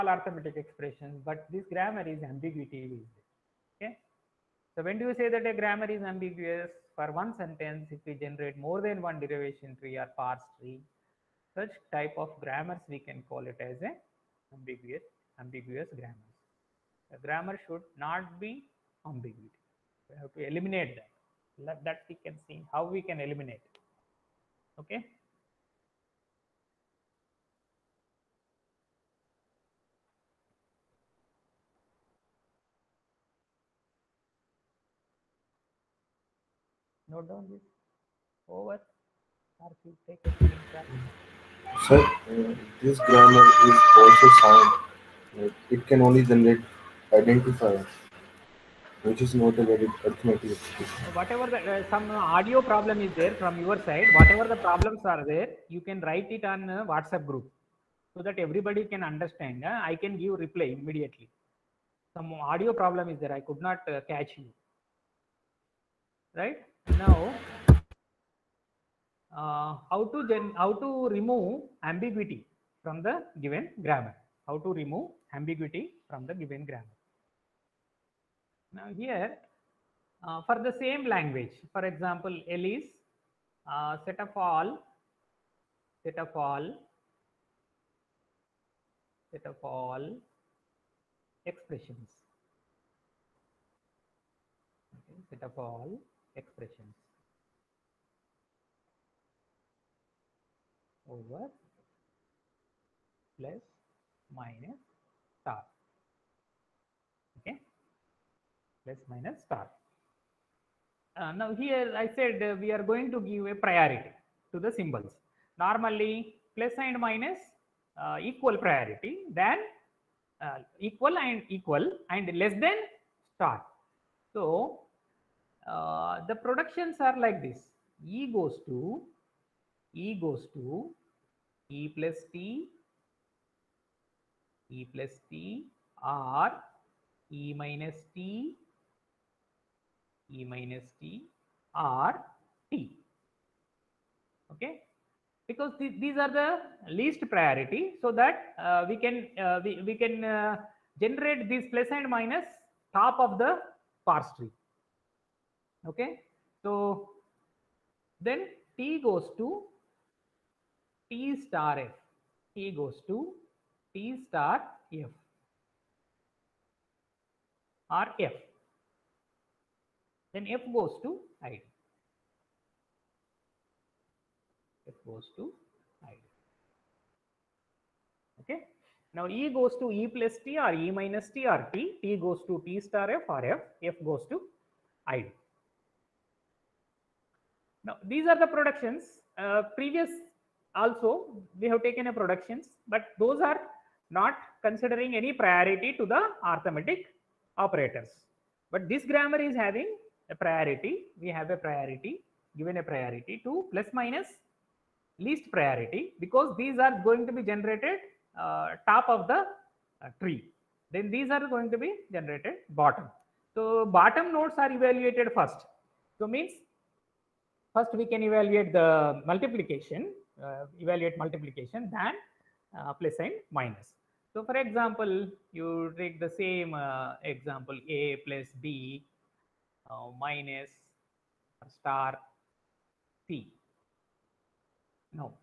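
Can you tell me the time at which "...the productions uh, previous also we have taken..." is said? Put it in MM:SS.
03:08.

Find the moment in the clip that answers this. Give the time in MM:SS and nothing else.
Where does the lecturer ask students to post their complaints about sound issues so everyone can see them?
00:56.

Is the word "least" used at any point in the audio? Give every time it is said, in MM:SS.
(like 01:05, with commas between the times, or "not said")
02:26, 03:25.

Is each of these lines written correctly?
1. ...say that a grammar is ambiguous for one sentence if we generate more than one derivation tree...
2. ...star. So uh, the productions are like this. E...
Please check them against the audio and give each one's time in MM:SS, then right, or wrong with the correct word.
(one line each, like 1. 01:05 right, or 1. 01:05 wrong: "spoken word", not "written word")
1. 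00:05 right
2. 02:03 right.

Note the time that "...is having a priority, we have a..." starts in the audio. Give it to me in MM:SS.
03:19.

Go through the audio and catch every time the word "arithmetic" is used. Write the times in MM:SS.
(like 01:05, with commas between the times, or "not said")
00:00, 00:50, 03:16.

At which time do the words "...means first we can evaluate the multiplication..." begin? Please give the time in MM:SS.
03:36.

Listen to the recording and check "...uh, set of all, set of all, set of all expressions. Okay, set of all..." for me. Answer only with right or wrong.
right.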